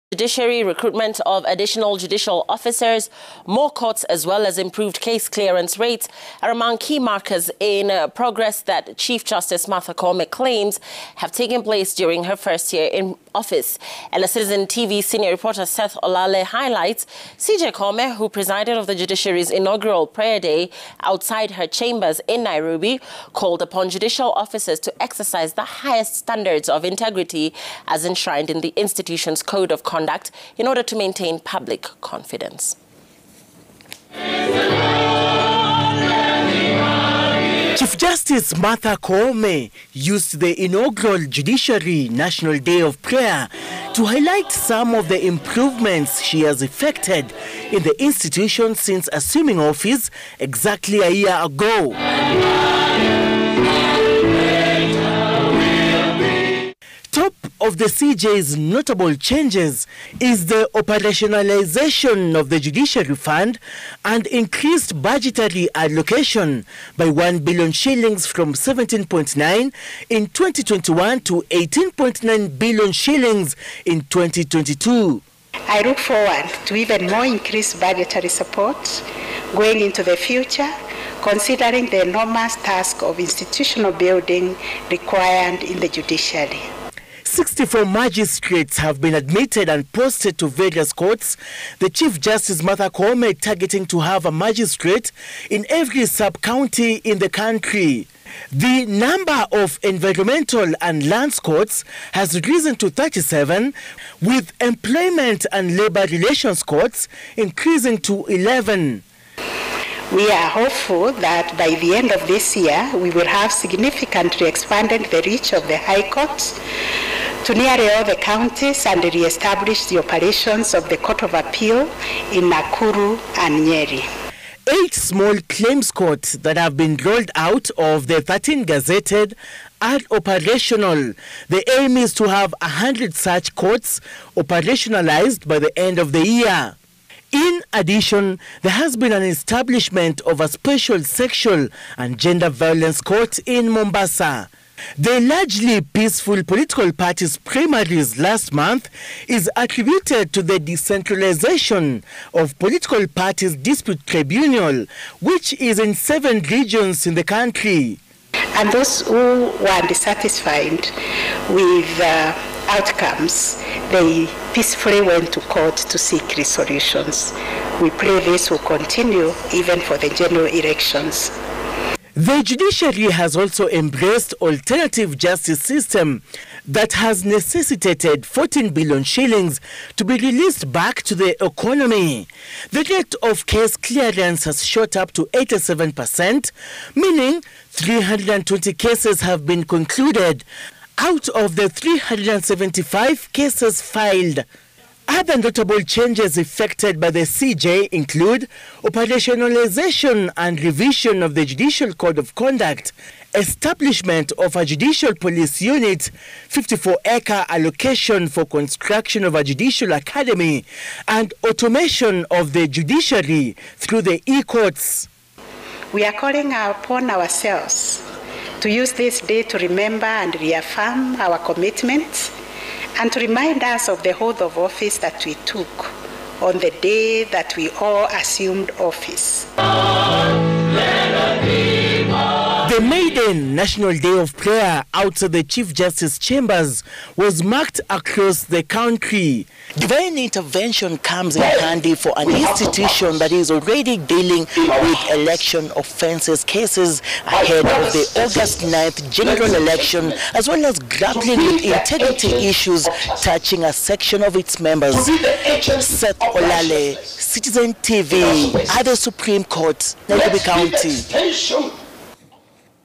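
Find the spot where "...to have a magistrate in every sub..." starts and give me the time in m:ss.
1:33.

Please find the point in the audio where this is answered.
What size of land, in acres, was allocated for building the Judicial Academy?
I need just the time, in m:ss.
3:26.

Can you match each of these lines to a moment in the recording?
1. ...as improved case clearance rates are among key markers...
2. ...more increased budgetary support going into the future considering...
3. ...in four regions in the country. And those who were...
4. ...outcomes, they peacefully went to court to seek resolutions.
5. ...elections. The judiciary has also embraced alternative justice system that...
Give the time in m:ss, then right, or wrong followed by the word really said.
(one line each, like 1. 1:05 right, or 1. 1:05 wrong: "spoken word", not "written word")
1. 0:04 right
2. 1:17 right
3. 2:35 wrong: "seven", not "four"
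4. 2:42 right
5. 2:50 right.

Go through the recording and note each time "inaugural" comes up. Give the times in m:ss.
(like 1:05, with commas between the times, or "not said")
0:19, 0:40.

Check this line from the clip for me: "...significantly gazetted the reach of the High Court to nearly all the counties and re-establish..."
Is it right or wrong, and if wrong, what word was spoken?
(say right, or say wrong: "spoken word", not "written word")
wrong: "expanded", not "gazetted".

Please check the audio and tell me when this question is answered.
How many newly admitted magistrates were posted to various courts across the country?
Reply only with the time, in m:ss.
1:27.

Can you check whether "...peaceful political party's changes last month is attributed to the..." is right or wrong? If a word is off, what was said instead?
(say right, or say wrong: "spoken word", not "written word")
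wrong: "primaries", not "changes".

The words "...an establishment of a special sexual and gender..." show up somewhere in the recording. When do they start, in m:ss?
2:19.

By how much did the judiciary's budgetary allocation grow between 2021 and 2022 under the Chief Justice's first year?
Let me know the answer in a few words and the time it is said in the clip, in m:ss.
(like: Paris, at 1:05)
1 billion shillings, at 1:07.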